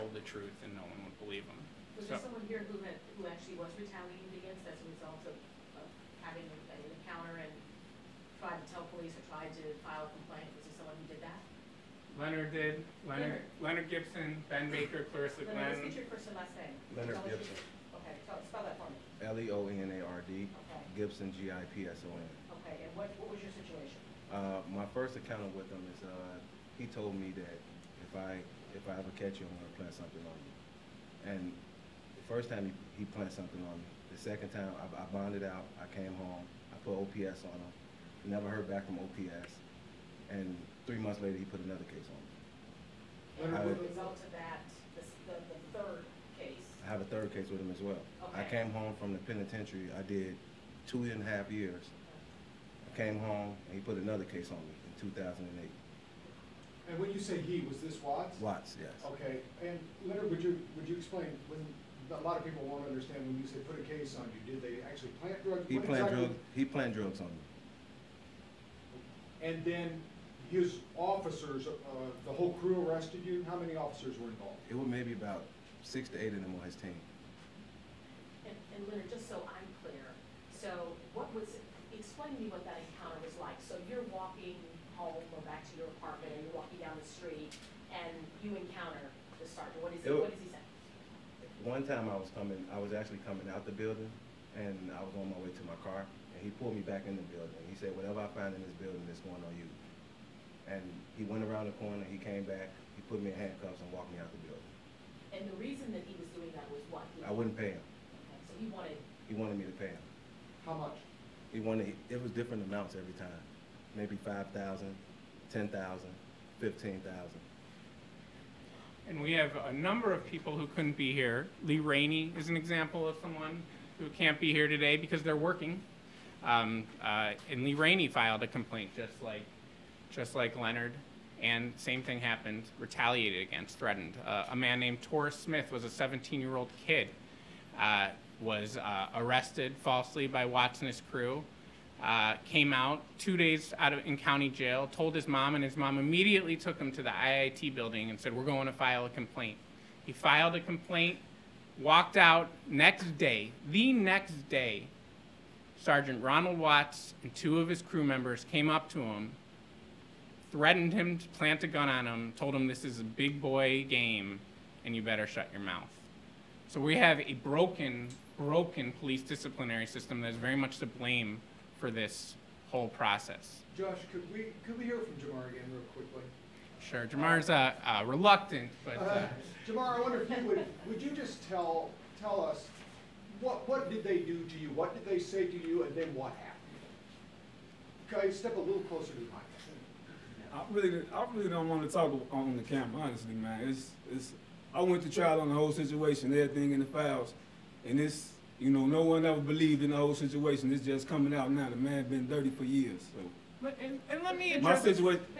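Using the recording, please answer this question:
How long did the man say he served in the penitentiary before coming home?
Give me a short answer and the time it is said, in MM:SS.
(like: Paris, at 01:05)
2.5 years, at 00:50.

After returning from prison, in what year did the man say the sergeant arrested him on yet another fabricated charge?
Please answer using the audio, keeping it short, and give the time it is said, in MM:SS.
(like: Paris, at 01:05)
2008, at 00:55.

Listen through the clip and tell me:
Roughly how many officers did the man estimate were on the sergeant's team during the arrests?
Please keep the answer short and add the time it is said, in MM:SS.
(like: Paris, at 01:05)
6 to 8, at 01:15.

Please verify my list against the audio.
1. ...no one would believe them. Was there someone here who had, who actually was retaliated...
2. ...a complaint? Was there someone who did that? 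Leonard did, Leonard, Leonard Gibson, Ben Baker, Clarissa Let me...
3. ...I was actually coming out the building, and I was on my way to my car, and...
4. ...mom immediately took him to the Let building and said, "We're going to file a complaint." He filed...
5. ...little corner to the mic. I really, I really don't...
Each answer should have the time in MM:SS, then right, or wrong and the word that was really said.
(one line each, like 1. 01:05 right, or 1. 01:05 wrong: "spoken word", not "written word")
1. 00:00 right
2. 00:10 right
3. 01:32 right
4. 02:25 wrong: "IIT", not "Let"
5. 03:08 wrong: "closer", not "corner".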